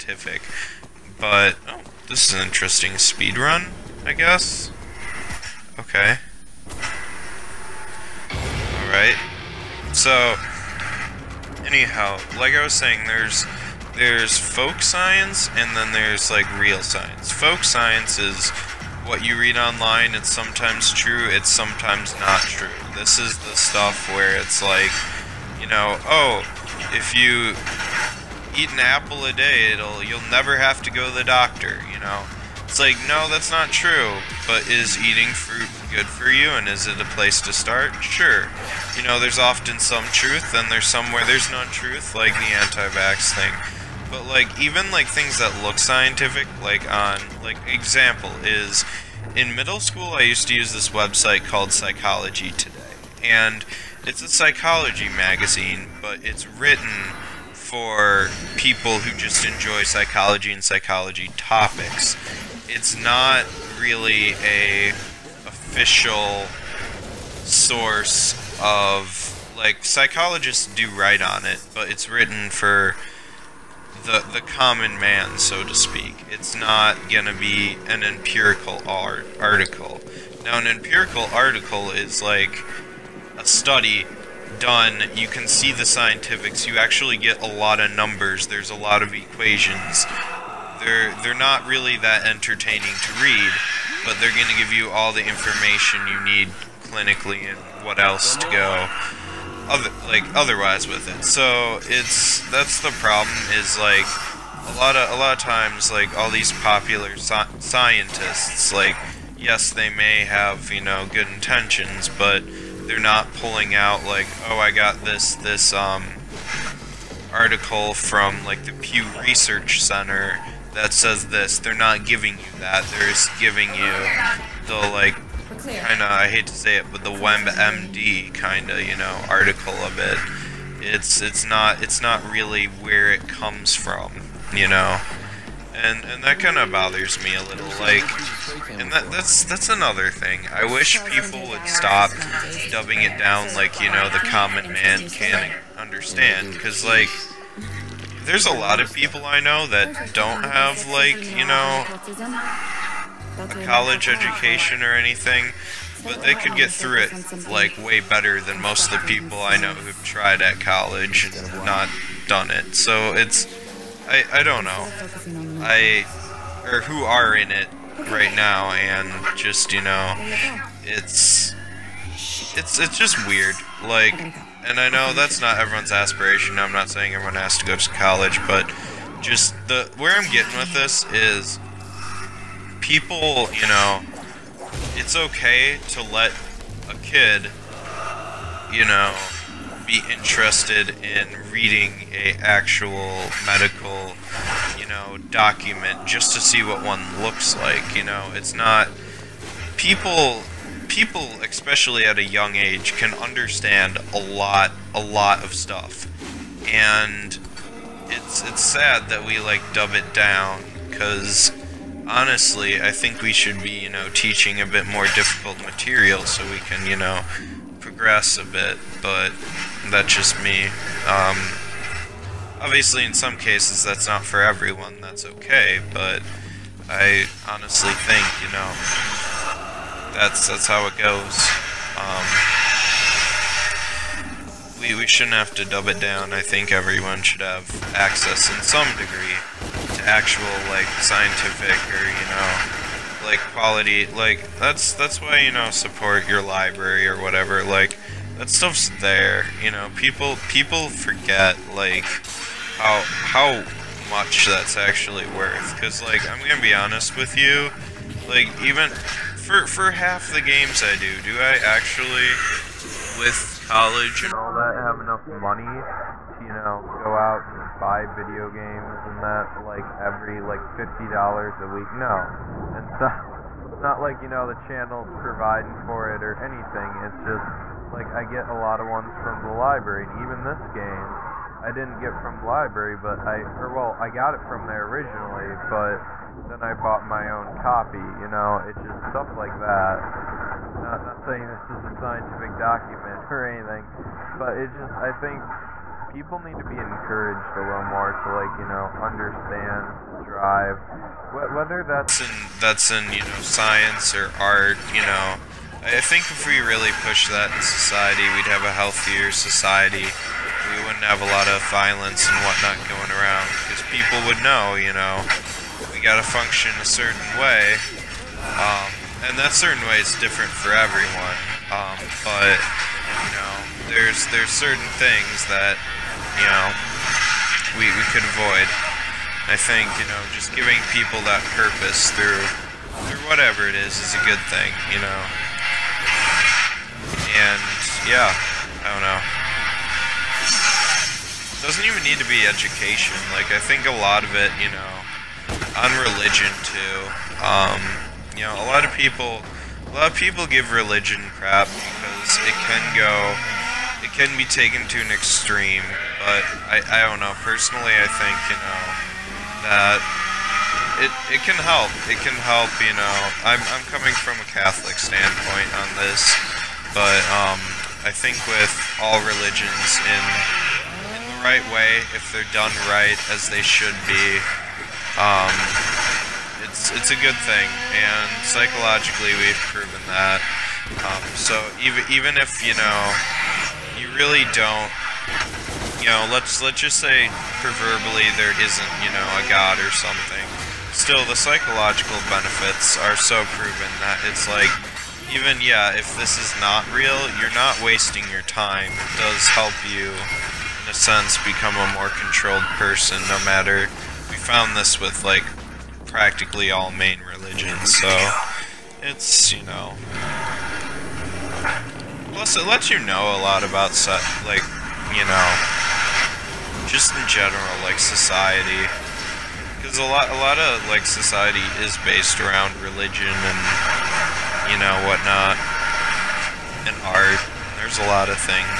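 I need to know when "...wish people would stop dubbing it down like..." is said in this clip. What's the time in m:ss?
2:20.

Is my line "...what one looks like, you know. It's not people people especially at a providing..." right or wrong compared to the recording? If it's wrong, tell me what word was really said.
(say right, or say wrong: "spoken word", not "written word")
wrong: "young", not "providing".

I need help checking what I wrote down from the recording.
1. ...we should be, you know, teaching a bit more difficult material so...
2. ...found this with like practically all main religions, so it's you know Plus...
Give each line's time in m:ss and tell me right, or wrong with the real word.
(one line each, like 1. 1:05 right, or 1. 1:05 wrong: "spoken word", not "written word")
1. 3:33 right
2. 6:44 right.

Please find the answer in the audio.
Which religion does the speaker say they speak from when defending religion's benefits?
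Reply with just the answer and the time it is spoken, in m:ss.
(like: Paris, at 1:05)
Catholic, at 6:04.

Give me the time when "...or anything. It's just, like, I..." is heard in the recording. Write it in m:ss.
4:36.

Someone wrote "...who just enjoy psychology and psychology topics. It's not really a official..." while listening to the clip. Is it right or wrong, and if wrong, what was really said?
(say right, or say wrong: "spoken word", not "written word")
right.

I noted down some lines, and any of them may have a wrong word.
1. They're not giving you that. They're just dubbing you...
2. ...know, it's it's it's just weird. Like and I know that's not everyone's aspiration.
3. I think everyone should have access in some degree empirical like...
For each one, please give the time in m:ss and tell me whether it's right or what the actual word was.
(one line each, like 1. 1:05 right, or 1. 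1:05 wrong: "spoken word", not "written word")
1. 2:01 wrong: "giving", not "dubbing"
2. 2:49 right
3. 3:56 wrong: "actual", not "empirical".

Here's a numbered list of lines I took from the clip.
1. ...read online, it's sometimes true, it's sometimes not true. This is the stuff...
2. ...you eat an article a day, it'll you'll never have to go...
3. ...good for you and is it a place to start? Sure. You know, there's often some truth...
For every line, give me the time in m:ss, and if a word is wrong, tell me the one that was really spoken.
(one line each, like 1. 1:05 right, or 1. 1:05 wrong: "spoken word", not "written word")
1. 0:19 right
2. 0:27 wrong: "apple", not "article"
3. 0:35 right.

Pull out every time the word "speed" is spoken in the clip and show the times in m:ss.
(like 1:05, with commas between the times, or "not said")
0:02.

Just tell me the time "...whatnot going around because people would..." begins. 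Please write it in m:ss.
5:12.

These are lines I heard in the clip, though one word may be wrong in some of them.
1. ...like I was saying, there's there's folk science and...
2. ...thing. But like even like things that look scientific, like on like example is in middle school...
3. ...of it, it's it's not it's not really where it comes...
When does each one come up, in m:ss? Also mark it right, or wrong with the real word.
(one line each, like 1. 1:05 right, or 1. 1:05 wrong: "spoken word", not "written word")
1. 0:12 right
2. 0:43 right
3. 2:09 right.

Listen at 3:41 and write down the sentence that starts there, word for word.
Um, obviously, in some cases, that's not for everyone, that's okay, but I honestly think, you know, that's, that's how it goes.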